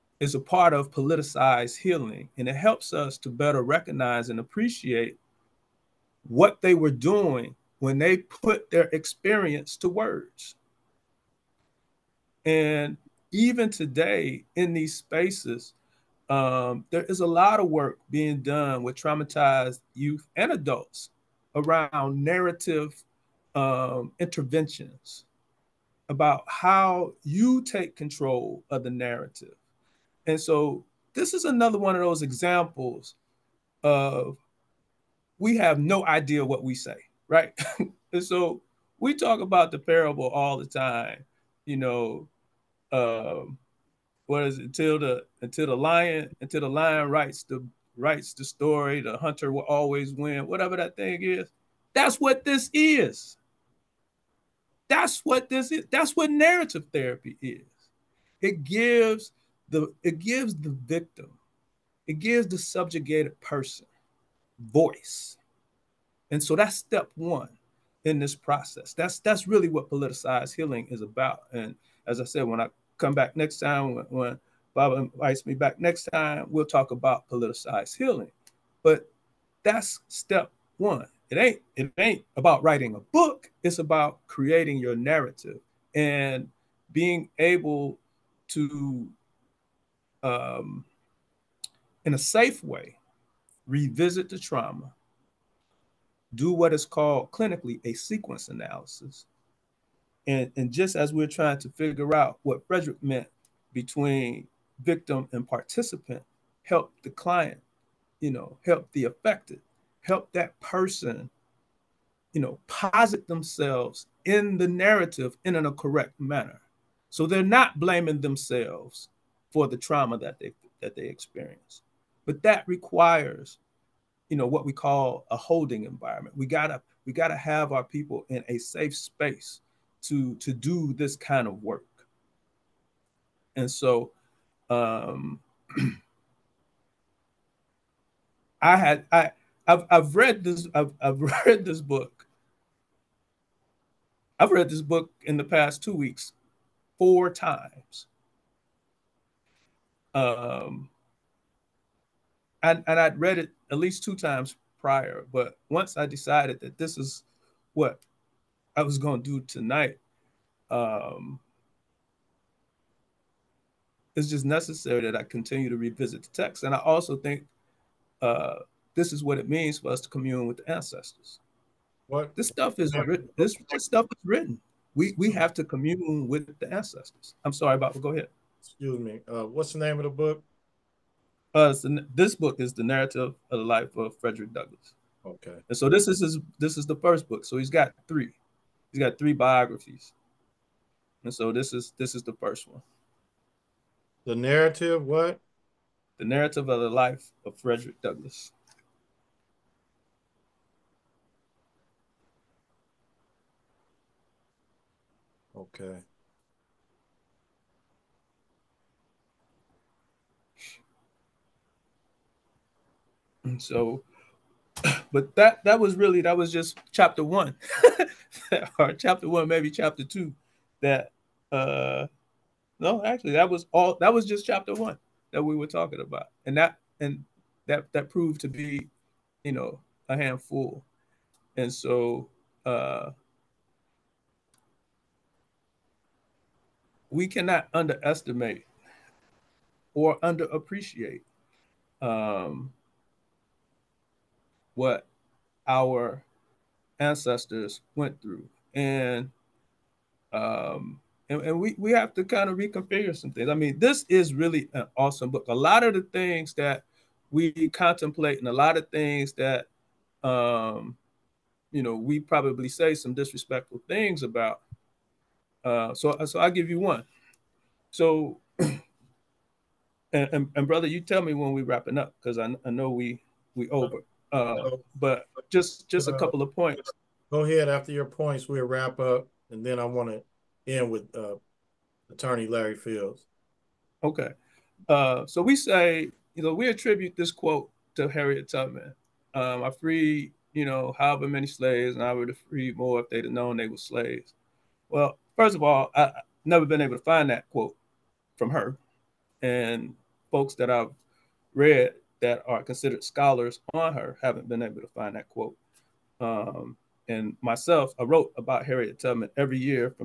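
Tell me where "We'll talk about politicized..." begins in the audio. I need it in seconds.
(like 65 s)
76 s.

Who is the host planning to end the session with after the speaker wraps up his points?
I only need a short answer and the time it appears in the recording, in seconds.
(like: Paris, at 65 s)
Attorney Larry Fields, at 282 s.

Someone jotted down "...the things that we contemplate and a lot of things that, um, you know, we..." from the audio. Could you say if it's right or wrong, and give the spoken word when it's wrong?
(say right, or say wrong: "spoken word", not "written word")
right.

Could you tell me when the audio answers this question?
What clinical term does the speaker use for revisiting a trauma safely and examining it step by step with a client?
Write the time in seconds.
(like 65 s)
97 s.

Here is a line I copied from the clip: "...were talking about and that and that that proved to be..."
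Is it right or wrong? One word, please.
right.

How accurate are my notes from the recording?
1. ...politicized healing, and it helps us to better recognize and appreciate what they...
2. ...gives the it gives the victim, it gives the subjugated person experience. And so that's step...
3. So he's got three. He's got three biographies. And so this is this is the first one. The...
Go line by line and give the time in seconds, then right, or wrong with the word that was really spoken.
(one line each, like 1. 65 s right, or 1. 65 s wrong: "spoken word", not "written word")
1. 0 s right
2. 58 s wrong: "voice", not "experience"
3. 187 s right.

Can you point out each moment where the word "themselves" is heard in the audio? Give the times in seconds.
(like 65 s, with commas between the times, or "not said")
113 s, 118 s.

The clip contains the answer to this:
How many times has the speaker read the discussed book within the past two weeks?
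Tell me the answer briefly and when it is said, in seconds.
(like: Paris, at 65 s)
4, at 146 s.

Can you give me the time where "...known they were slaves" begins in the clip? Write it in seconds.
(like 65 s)
293 s.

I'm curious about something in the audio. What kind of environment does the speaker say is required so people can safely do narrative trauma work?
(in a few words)
holding environment.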